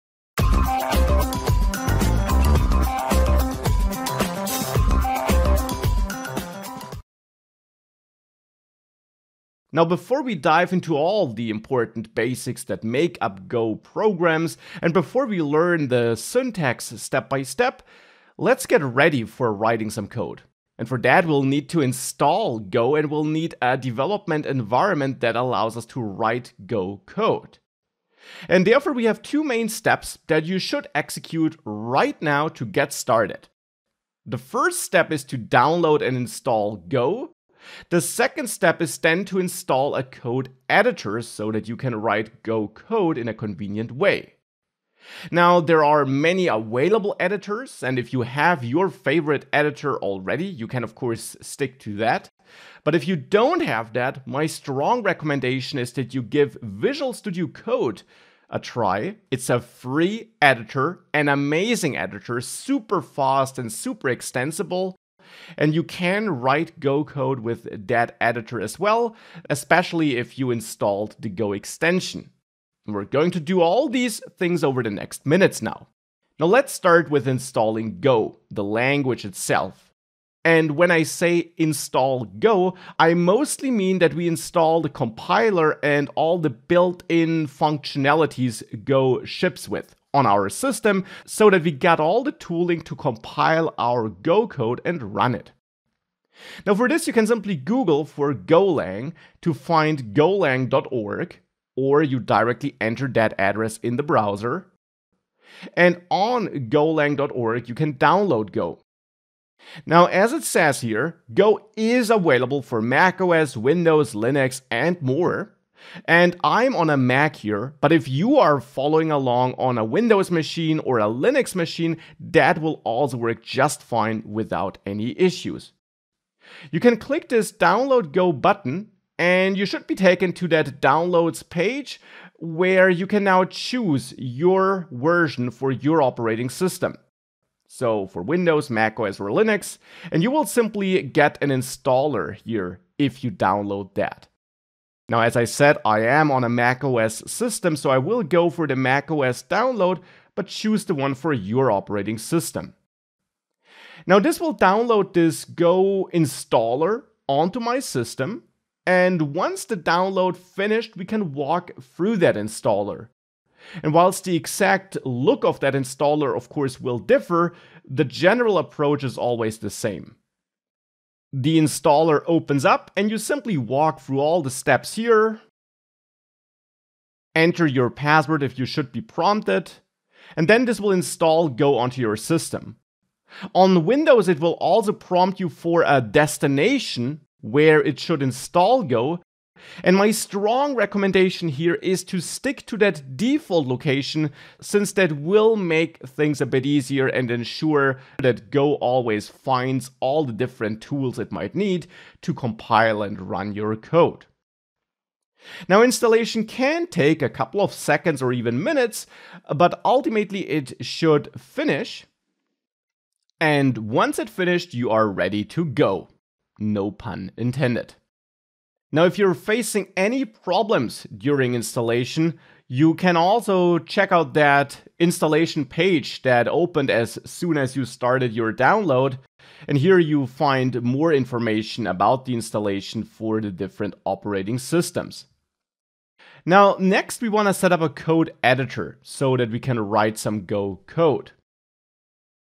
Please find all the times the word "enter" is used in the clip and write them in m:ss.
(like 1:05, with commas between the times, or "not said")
1:42, 2:57.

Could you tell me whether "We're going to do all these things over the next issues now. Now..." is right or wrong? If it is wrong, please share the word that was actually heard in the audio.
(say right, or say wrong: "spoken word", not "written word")
wrong: "minutes", not "issues".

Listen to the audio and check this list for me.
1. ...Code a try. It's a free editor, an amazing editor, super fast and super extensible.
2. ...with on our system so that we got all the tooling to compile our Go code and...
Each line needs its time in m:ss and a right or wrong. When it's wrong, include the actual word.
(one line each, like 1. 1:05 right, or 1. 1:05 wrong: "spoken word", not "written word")
1. 0:57 right
2. 1:29 right.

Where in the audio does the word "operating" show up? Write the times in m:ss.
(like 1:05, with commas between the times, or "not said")
2:16, 2:31, 3:54.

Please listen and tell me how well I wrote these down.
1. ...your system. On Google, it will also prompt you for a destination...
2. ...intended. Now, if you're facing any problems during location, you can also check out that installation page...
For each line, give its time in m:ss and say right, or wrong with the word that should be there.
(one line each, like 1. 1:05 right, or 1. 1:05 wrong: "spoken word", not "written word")
1. 3:02 wrong: "Windows", not "Google"
2. 3:37 wrong: "installation", not "location".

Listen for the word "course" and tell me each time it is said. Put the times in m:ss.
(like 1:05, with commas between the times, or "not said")
0:50, 2:46.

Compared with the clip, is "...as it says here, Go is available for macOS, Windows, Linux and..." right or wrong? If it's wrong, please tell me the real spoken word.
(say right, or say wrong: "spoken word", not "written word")
right.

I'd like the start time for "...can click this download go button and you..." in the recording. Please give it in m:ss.
2:06.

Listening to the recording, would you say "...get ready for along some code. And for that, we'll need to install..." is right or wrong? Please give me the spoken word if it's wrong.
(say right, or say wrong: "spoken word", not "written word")
wrong: "writing", not "along".